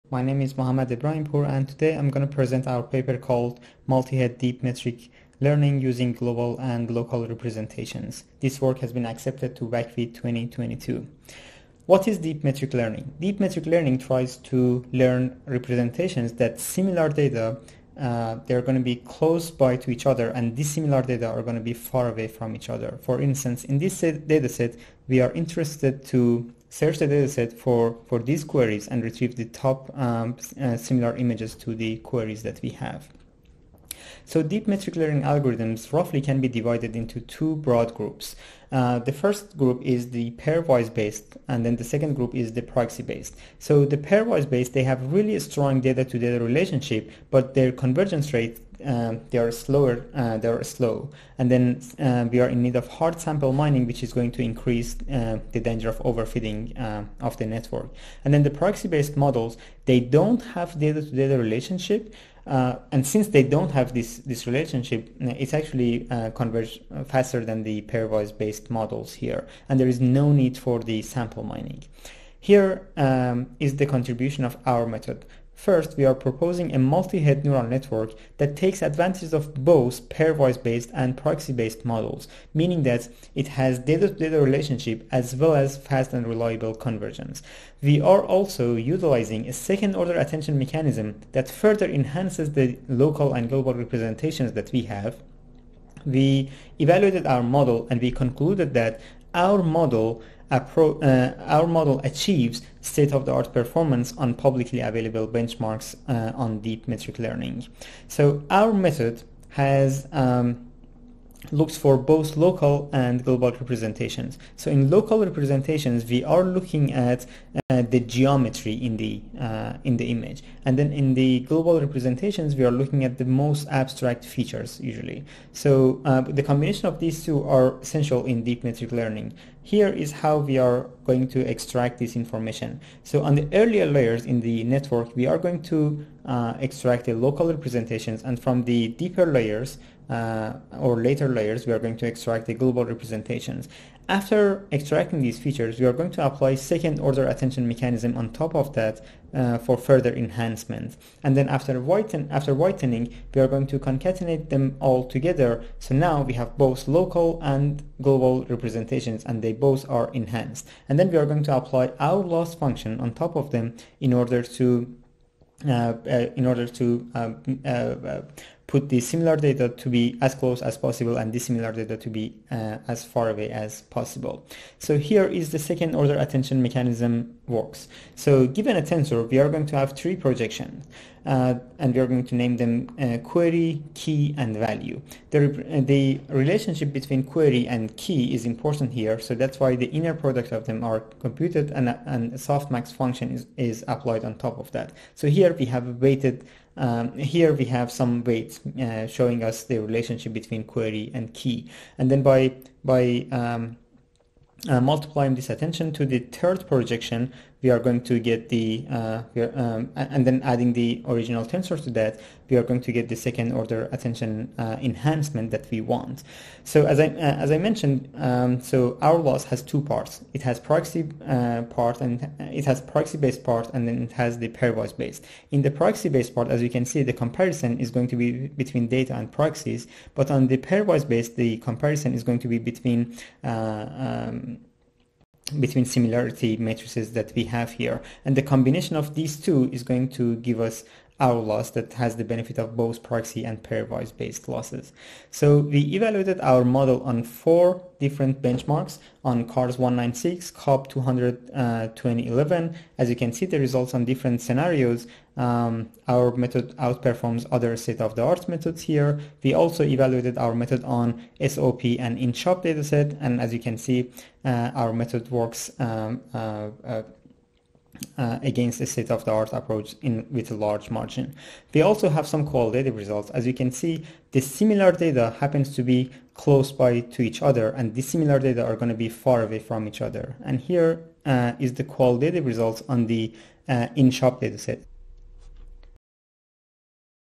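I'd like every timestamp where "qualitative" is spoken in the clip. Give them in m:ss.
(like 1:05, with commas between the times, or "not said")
4:32, 4:41.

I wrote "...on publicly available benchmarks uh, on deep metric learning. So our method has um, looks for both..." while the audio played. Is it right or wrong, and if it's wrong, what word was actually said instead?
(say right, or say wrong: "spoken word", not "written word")
right.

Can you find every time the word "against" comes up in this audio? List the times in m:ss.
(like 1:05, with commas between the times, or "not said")
4:28.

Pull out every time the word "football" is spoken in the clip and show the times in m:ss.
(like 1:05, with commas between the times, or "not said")
not said.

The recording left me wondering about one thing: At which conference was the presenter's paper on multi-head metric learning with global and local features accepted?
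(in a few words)
WACV 2022.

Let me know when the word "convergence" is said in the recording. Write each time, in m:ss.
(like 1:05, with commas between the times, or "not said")
0:47, 1:26.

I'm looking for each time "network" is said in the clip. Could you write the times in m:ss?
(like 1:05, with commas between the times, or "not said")
0:57, 1:17, 2:14.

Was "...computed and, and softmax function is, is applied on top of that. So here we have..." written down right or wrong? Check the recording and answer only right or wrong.
right.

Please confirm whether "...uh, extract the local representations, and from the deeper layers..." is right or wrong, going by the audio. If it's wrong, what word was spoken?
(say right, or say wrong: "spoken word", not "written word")
right.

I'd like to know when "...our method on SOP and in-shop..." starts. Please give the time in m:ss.
4:20.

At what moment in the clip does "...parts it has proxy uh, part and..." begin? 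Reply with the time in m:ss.
3:39.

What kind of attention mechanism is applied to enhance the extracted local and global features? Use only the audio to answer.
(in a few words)
second-order attention.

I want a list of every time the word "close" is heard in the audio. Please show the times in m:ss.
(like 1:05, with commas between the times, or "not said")
0:18, 2:50, 4:36.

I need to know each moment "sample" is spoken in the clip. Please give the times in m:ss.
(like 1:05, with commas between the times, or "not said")
0:53, 1:11.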